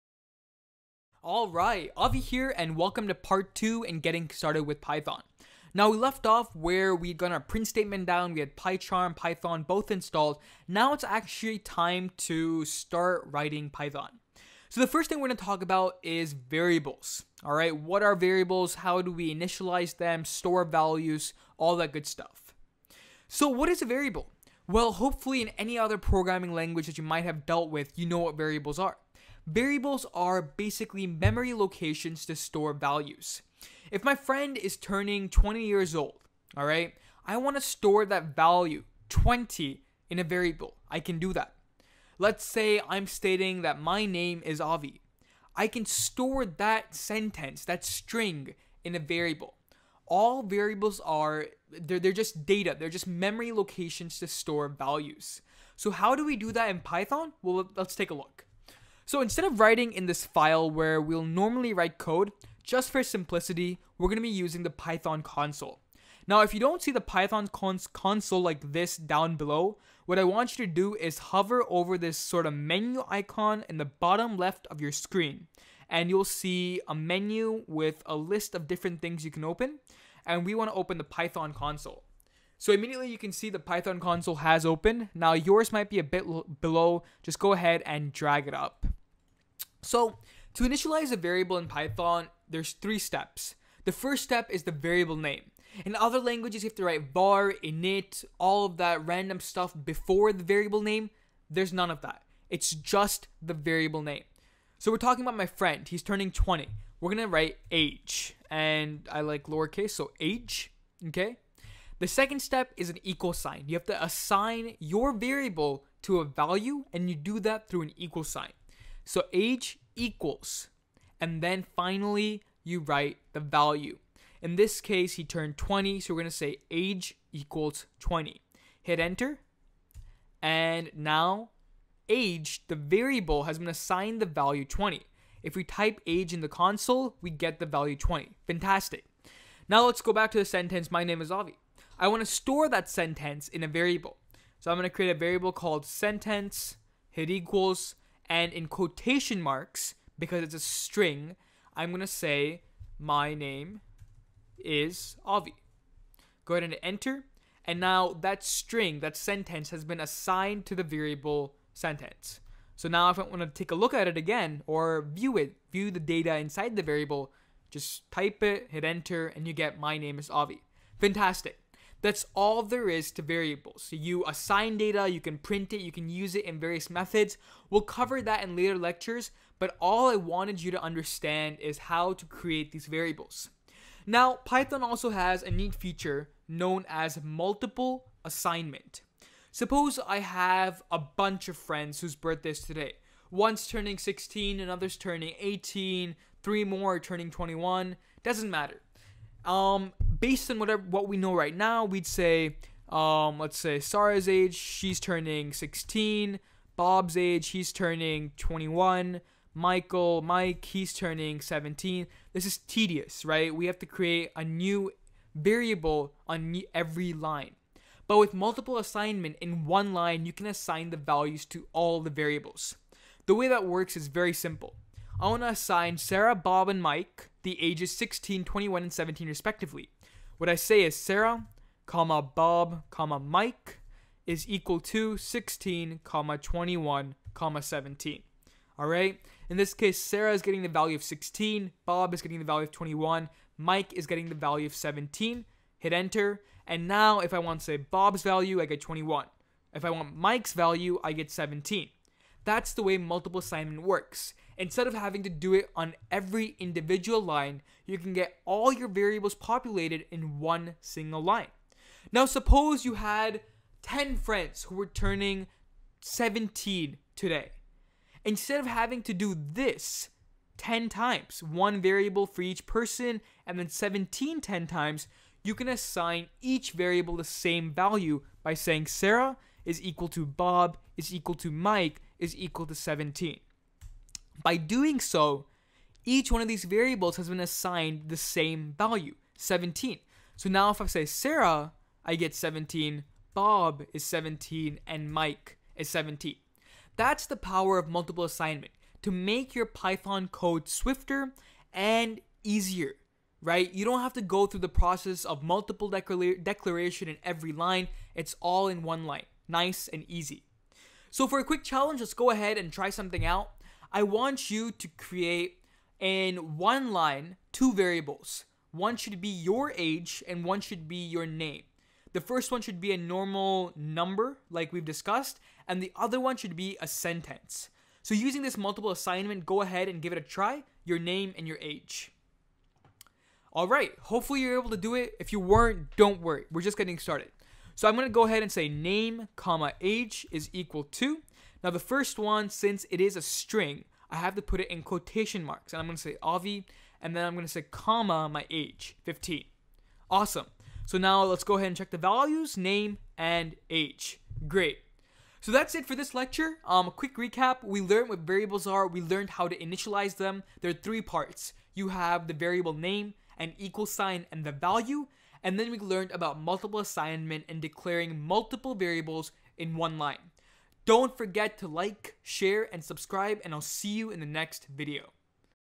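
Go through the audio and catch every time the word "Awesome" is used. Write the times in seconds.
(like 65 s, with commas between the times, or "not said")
350 s.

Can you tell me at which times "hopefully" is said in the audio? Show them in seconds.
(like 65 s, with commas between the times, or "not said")
24 s, 334 s.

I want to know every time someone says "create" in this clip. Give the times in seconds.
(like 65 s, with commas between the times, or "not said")
144 s, 182 s, 213 s, 314 s.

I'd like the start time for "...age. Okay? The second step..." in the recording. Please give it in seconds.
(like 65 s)
110 s.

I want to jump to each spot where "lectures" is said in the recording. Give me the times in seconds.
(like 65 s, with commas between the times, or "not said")
178 s, 356 s.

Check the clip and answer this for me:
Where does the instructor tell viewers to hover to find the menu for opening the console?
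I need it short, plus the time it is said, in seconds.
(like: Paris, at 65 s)
bottom left, at 73 s.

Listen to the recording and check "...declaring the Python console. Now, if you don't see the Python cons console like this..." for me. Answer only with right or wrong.
wrong.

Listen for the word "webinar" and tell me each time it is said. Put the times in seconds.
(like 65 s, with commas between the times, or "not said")
not said.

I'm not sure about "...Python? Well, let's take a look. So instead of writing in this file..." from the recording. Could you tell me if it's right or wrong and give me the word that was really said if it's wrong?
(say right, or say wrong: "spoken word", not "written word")
right.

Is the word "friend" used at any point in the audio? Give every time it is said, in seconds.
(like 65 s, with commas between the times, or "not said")
34 s, 105 s, 191 s, 264 s.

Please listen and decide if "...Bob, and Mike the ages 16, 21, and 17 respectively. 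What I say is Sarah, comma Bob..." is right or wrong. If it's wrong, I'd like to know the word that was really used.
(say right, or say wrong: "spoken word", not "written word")
right.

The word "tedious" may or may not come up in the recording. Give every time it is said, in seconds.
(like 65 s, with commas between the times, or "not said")
212 s.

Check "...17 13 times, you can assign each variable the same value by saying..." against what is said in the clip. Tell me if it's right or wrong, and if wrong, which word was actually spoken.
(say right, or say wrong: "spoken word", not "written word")
wrong: "10", not "13".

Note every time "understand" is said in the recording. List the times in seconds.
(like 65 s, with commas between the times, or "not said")
180 s.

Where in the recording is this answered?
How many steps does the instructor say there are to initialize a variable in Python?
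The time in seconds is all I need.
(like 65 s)
92 s.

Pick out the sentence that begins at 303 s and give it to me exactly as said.
You don't have to go through the process of multiple declaration in every line.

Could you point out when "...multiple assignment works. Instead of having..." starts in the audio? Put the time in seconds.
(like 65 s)
252 s.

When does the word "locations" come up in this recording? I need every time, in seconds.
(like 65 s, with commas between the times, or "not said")
31 s, 53 s.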